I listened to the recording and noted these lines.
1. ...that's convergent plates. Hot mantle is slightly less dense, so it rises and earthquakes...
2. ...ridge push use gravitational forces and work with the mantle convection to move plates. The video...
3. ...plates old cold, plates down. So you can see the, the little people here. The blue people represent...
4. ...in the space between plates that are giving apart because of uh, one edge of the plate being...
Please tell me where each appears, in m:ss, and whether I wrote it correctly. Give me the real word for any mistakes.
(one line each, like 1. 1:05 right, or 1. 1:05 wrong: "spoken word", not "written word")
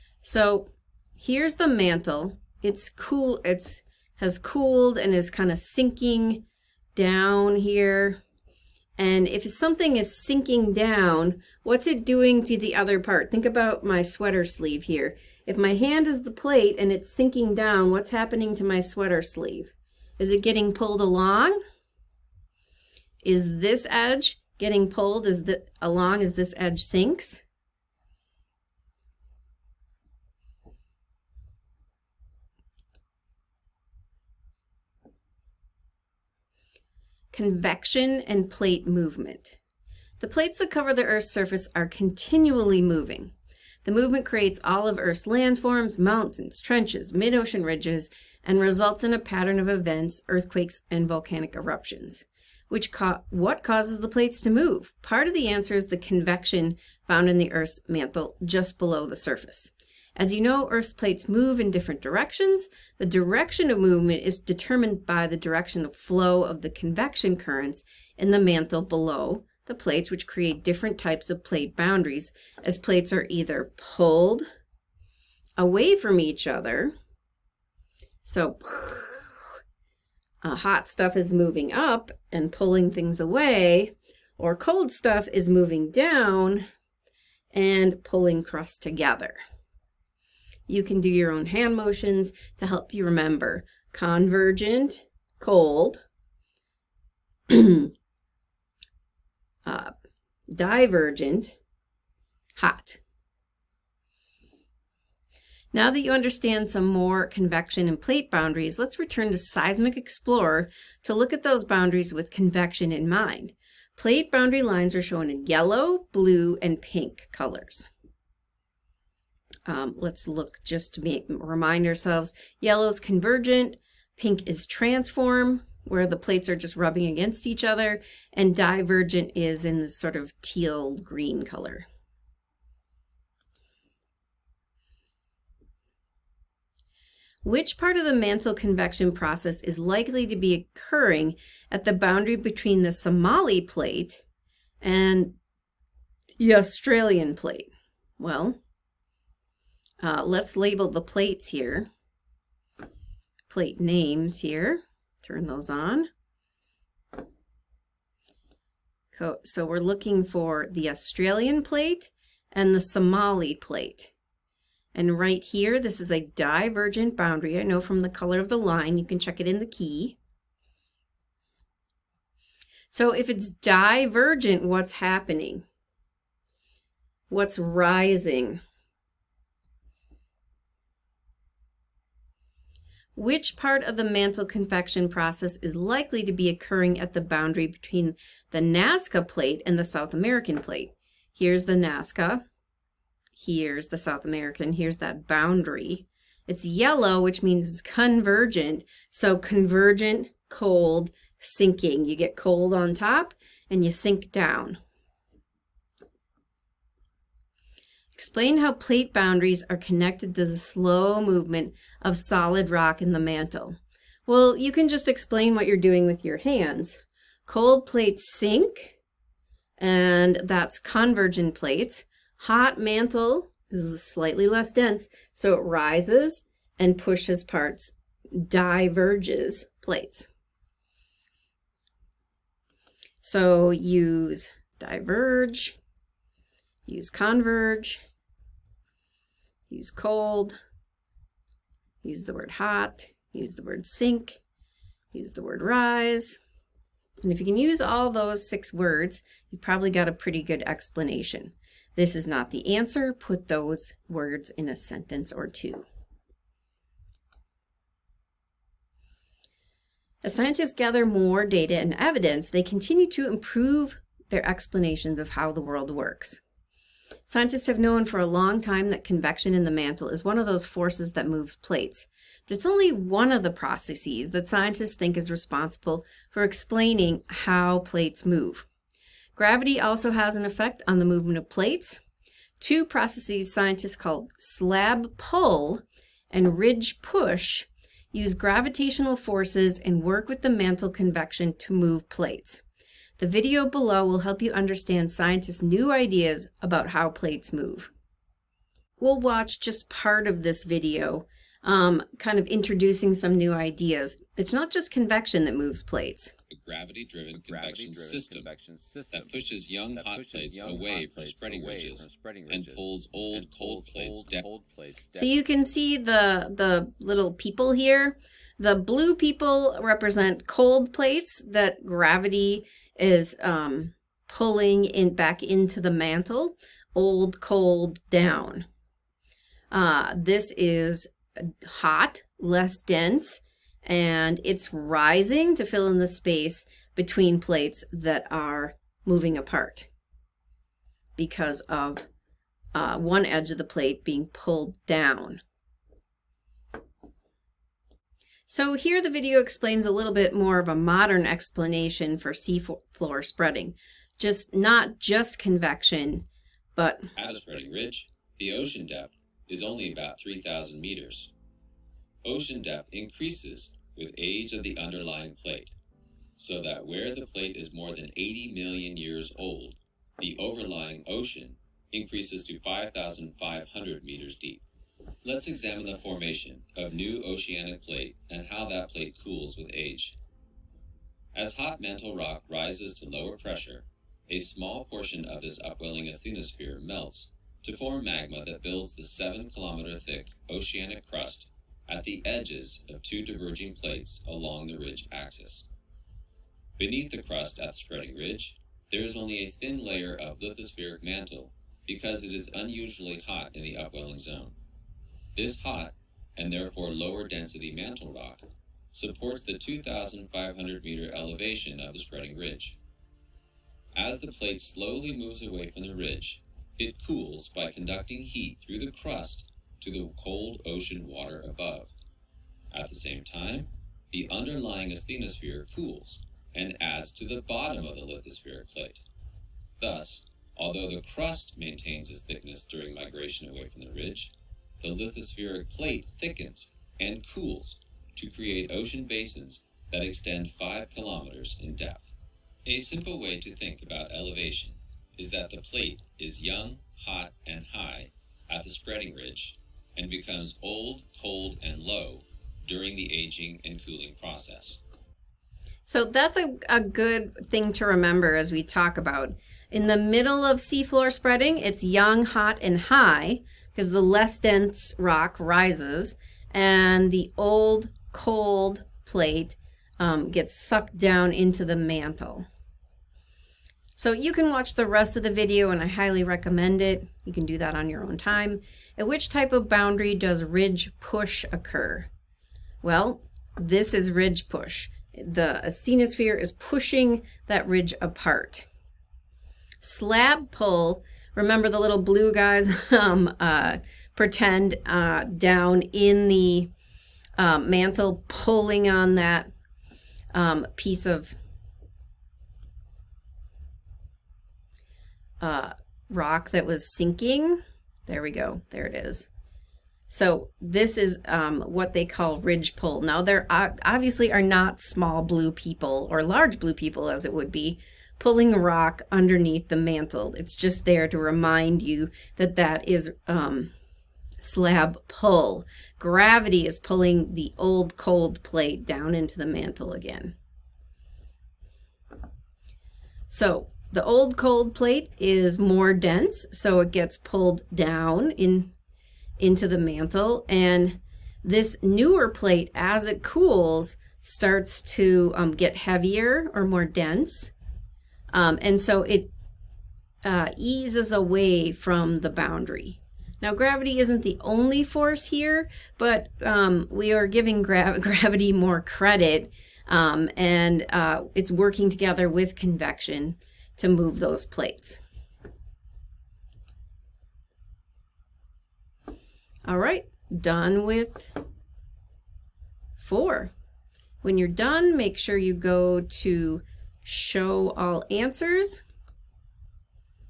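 1. 3:40 wrong: "pushes", not "earthquakes"
2. 4:46 right
3. 5:13 right
4. 5:35 wrong: "moving", not "giving".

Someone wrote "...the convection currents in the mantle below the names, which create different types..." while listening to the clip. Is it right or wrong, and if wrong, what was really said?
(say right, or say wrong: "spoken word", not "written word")
wrong: "plates", not "names".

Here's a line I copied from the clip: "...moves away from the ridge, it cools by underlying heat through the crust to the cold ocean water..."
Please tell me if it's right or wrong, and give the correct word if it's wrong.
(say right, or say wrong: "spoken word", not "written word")
wrong: "conducting", not "underlying".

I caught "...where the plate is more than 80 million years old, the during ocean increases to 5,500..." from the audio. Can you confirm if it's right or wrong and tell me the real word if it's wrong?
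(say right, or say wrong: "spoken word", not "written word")
wrong: "overlying", not "during".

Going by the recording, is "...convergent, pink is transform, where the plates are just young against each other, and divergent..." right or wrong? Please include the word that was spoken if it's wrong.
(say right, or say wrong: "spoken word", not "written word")
wrong: "rubbing", not "young".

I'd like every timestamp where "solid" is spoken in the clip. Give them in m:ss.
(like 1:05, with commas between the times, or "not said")
3:32.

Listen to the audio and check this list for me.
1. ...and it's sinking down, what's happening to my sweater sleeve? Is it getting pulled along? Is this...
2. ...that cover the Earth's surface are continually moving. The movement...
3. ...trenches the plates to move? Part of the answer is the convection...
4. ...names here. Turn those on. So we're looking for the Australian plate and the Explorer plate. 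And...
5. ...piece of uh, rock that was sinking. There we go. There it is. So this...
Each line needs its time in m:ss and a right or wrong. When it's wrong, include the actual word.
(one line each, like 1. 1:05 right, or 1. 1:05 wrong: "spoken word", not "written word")
1. 0:16 right
2. 0:40 right
3. 0:53 wrong: "causes", not "trenches"
4. 2:33 wrong: "Somali", not "Explorer"
5. 8:20 right.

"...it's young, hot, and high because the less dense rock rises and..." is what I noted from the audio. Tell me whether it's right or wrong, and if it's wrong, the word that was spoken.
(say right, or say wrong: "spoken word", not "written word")
right.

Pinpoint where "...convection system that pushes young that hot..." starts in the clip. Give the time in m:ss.
5:08.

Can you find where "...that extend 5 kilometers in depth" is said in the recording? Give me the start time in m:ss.
7:19.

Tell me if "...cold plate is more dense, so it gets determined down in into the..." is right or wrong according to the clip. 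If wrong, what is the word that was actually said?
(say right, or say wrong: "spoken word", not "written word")
wrong: "pulled", not "determined".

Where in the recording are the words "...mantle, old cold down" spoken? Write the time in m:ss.
5:25.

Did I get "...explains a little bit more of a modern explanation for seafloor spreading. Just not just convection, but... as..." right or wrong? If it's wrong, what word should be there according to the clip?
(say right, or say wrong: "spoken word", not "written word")
right.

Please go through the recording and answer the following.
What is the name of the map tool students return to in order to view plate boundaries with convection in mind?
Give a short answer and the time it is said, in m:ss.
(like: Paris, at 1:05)
Seismic Explorer, at 1:49.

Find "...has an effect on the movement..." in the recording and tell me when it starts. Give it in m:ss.
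4:40.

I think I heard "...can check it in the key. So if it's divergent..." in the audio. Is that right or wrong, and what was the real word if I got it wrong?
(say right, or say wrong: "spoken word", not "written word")
right.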